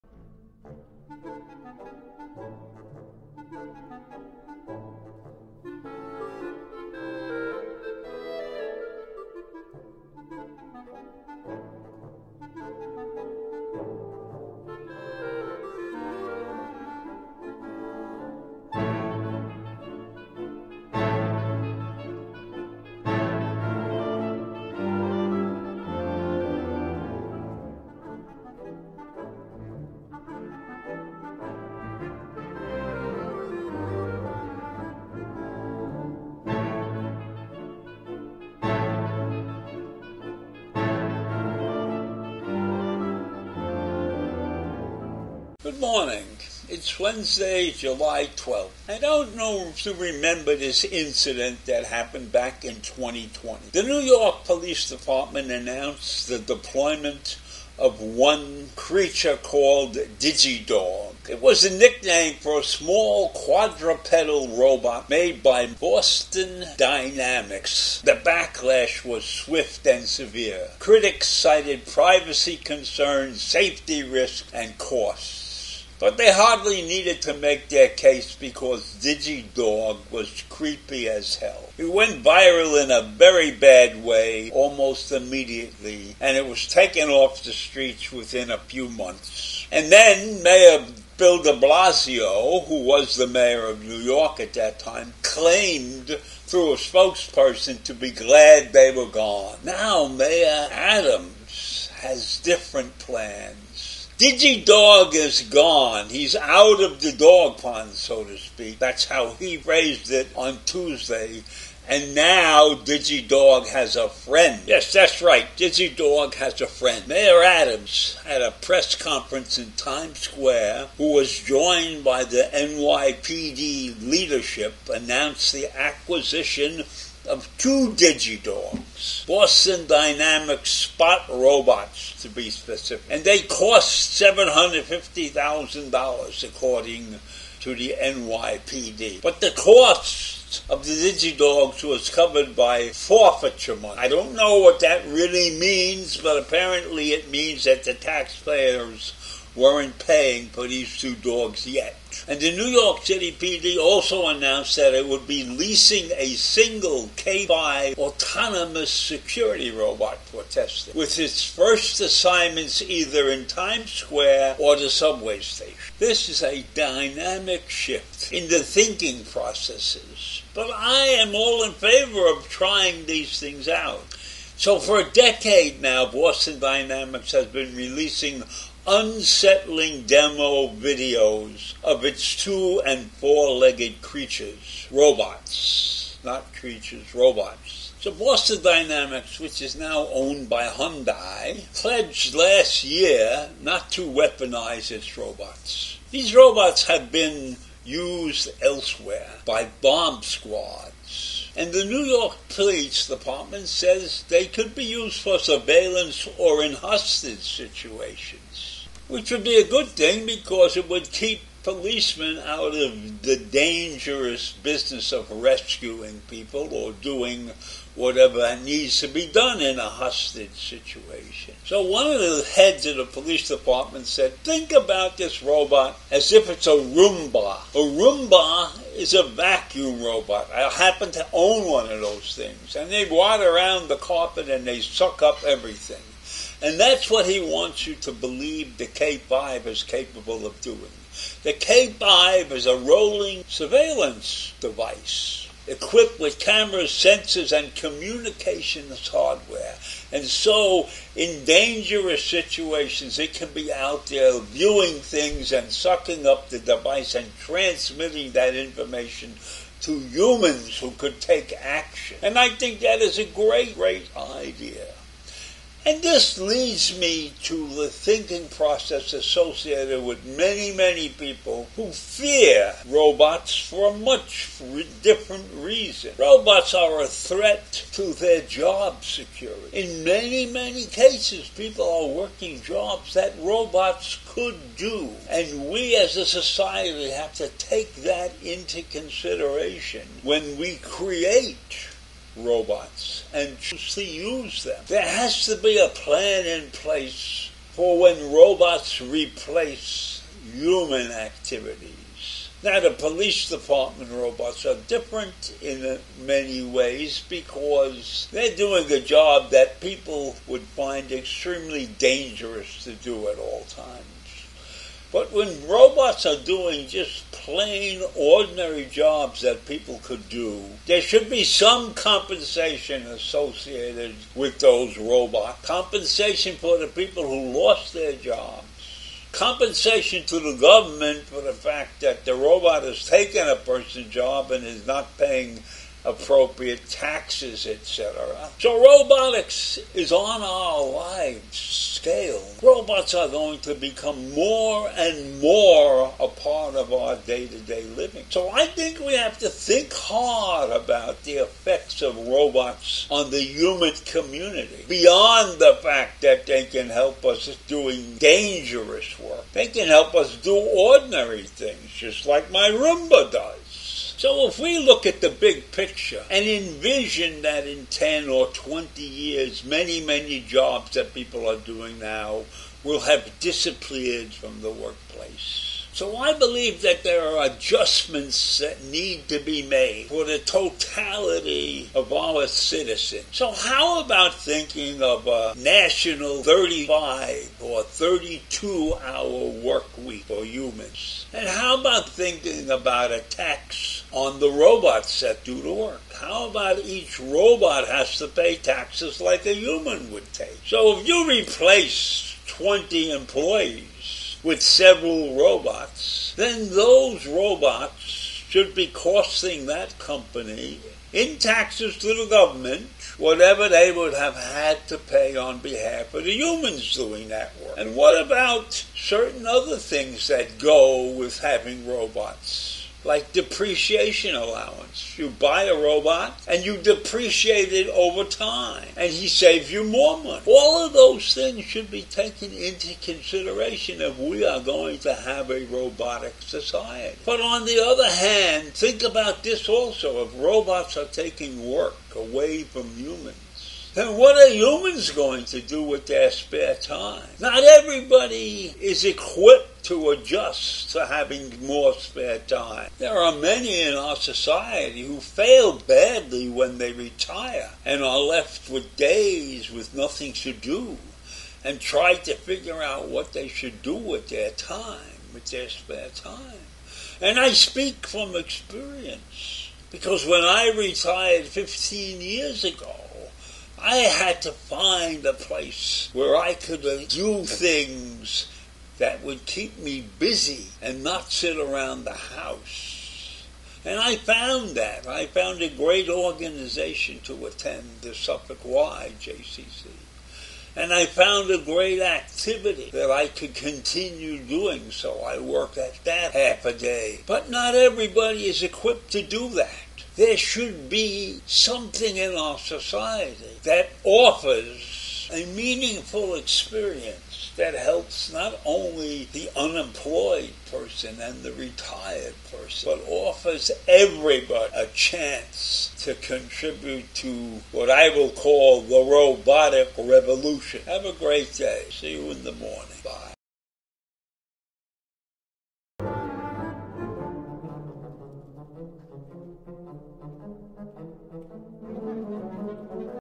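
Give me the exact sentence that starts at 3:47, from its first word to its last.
A Roomba is a vacuum robot.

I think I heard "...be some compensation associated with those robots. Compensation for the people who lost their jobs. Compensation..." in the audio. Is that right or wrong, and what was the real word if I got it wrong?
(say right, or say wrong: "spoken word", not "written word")
right.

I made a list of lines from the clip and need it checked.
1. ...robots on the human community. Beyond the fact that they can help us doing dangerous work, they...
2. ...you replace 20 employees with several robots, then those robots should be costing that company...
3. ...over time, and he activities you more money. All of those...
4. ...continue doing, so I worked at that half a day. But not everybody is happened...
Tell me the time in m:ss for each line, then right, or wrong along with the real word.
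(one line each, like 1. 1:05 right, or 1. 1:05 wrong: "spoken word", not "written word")
1. 5:52 right
2. 6:41 right
3. 7:07 wrong: "saves", not "activities"
4. 8:13 wrong: "equipped", not "happened".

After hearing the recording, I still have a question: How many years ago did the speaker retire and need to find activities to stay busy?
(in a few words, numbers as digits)
15.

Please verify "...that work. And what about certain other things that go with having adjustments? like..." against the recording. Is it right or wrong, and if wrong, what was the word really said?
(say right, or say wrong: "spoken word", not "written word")
wrong: "robots", not "adjustments".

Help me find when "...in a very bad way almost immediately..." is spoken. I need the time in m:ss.
1:22.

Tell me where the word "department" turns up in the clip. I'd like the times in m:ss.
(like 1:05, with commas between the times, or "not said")
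0:54, 3:23, 3:43, 5:03.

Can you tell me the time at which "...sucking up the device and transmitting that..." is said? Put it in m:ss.
4:15.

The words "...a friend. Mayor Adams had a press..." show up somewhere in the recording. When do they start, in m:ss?
1:56.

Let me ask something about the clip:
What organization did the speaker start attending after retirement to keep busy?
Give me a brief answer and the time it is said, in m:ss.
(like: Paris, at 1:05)
Suffolk Y JCC, at 8:08.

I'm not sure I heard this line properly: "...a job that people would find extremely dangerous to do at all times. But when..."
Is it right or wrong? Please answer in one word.
right.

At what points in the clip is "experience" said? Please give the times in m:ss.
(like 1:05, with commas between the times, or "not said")
7:48, 8:26.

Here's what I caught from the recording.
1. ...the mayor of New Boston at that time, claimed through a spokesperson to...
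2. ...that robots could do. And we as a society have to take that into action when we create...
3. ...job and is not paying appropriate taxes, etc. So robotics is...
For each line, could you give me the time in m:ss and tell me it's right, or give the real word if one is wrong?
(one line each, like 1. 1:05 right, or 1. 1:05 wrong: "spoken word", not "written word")
1. 1:33 wrong: "York", not "Boston"
2. 4:43 wrong: "consideration", not "action"
3. 5:34 right.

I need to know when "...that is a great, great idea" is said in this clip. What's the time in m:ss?
4:22.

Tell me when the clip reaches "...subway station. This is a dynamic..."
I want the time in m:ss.
2:44.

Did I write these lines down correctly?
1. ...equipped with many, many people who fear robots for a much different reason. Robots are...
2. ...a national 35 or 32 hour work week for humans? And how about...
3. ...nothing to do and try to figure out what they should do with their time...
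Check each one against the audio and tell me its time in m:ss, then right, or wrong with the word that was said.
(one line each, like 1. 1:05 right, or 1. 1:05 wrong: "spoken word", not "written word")
1. 4:29 wrong: "associated", not "equipped"
2. 6:25 right
3. 7:39 right.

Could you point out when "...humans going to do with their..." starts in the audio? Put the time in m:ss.
7:24.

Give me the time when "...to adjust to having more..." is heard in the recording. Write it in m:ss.
7:29.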